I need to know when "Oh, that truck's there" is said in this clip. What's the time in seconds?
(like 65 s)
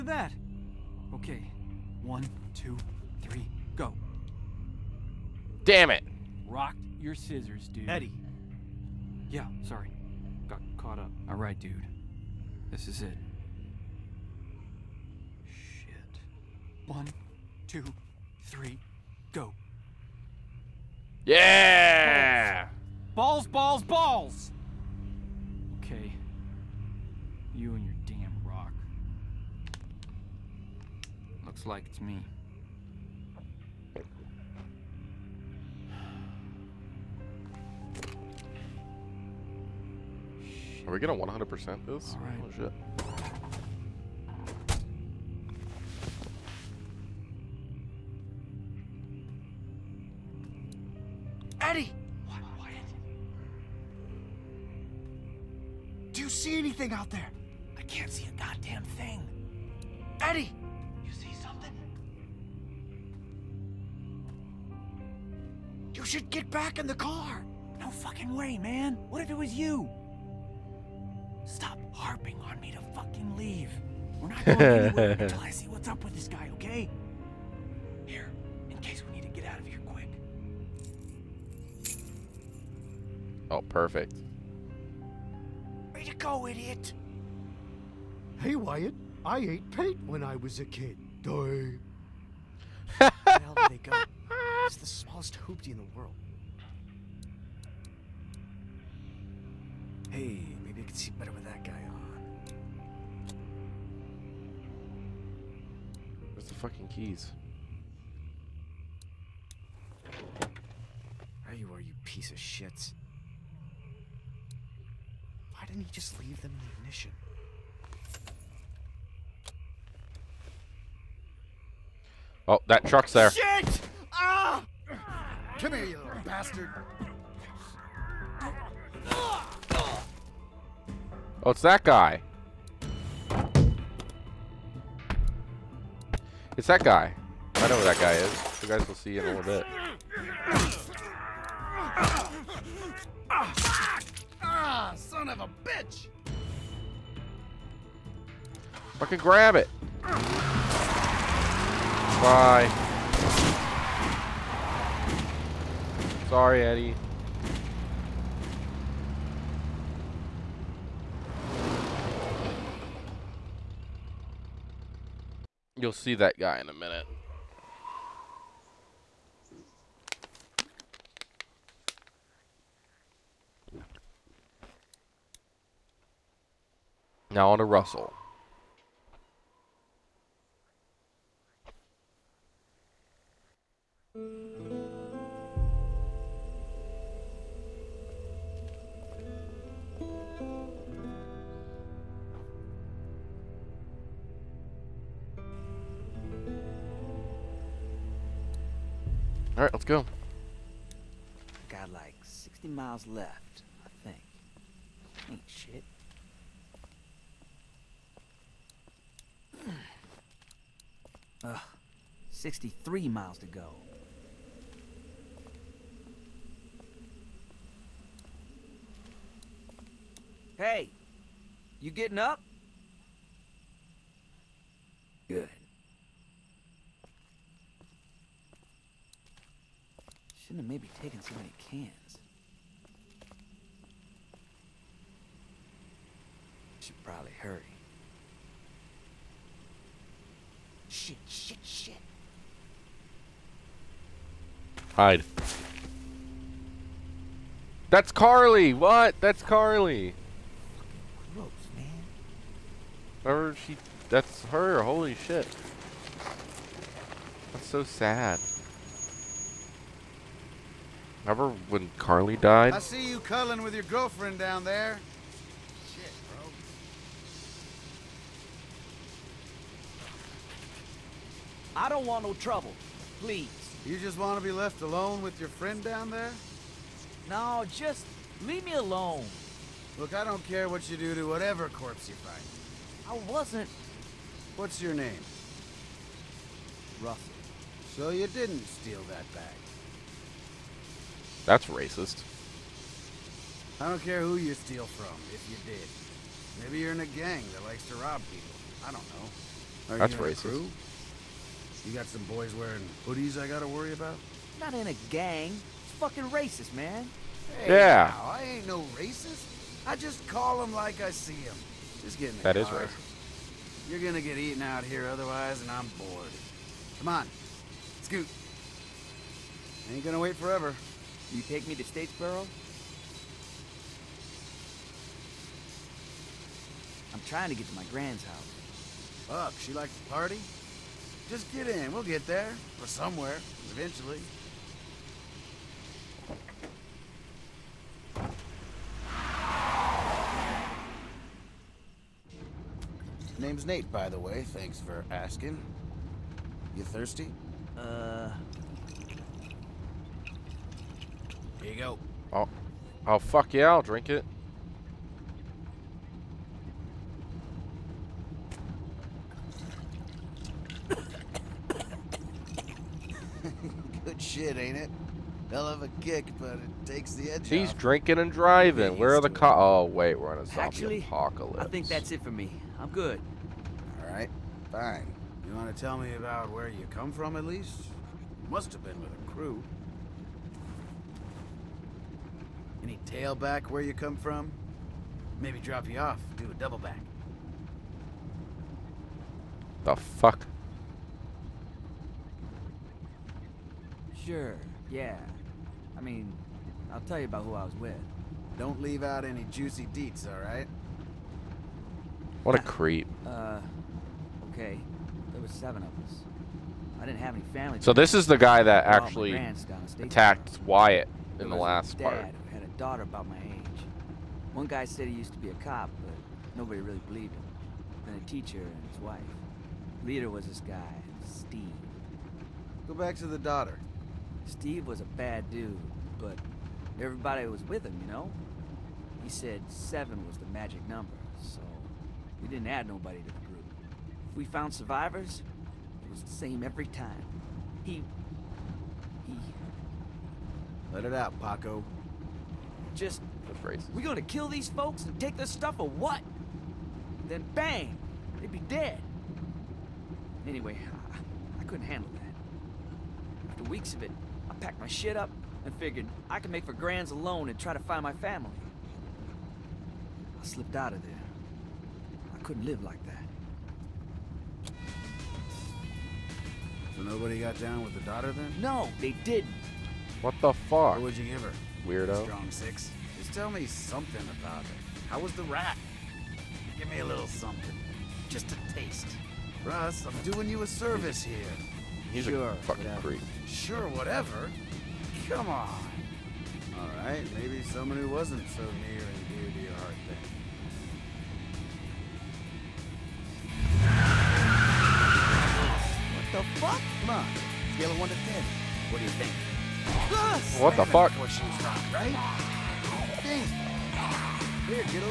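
122 s.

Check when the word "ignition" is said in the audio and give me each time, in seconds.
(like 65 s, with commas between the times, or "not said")
116 s.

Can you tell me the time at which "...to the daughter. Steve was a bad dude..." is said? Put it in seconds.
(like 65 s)
423 s.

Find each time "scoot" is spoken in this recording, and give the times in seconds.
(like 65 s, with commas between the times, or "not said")
318 s.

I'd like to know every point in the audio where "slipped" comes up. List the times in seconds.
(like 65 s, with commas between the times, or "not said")
460 s.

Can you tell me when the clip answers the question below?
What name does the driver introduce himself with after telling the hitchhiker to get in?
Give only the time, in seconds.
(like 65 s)
343 s.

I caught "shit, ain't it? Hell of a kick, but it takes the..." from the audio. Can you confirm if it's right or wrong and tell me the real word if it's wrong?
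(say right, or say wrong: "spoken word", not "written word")
right.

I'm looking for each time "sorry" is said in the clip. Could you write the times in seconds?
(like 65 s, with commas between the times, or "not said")
9 s, 156 s.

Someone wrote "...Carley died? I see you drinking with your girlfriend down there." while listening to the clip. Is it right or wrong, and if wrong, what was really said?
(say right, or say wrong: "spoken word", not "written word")
wrong: "cuddling", not "drinking".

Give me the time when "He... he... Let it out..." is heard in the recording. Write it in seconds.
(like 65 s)
437 s.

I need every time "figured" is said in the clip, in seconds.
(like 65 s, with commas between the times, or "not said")
455 s.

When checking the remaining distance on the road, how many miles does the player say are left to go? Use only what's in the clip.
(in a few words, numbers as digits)
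63.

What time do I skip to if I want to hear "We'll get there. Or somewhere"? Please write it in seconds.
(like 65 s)
331 s.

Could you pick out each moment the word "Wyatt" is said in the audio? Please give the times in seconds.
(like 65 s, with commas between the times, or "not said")
88 s, 410 s.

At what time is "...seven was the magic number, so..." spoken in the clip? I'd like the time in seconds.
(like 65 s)
429 s.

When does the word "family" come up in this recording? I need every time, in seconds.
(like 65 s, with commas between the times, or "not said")
407 s, 458 s.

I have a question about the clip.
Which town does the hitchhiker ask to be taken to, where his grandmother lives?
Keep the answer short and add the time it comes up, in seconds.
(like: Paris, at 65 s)
Statesboro, at 321 s.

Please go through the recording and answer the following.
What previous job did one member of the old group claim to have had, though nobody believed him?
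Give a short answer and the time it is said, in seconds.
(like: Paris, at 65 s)
cop, at 415 s.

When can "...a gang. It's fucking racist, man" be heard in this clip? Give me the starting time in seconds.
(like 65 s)
304 s.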